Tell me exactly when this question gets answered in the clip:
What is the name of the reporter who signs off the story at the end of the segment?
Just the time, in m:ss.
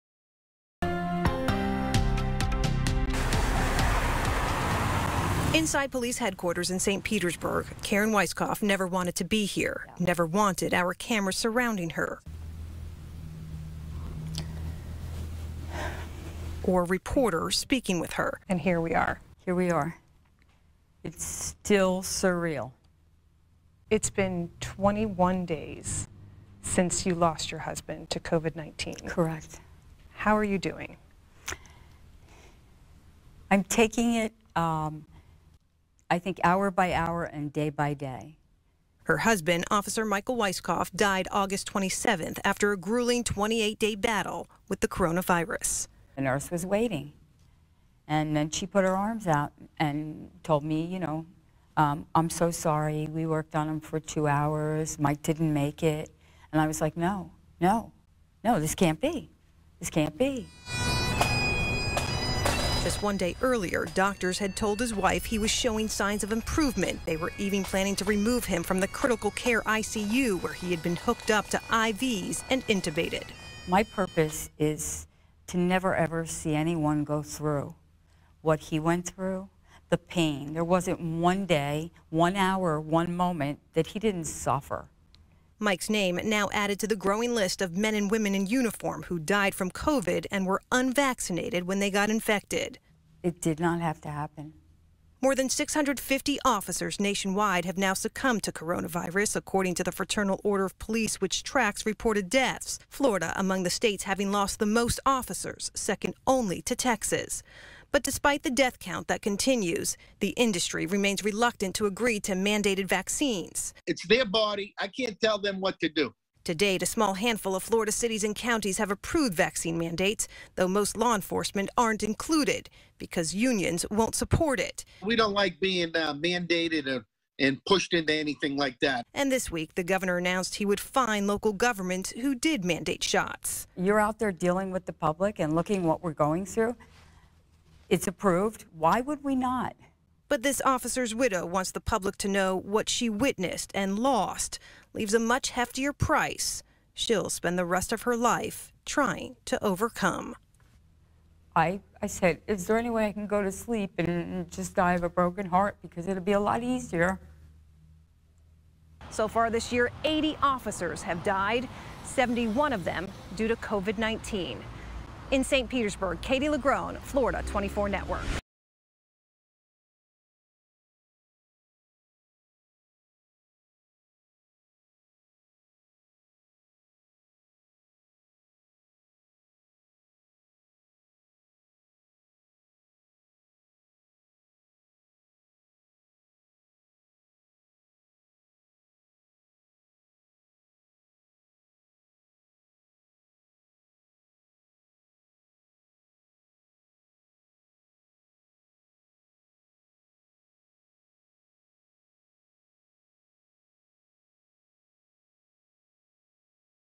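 2:46.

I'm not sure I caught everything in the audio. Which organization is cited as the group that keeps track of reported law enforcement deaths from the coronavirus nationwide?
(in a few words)
Fraternal Order of Police.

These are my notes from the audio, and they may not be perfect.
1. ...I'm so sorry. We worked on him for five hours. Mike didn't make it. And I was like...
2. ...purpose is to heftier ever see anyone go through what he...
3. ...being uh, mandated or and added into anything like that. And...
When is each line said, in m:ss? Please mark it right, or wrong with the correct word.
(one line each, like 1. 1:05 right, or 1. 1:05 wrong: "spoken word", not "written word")
1. 0:52 wrong: "two", not "five"
2. 1:13 wrong: "never", not "heftier"
3. 2:05 wrong: "pushed", not "added".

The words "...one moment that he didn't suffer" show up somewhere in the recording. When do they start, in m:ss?
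1:22.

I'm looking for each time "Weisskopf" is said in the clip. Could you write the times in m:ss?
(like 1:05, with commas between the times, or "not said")
0:08, 0:40.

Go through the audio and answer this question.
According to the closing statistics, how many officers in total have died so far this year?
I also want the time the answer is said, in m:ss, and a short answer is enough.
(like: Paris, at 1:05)
80, at 2:40.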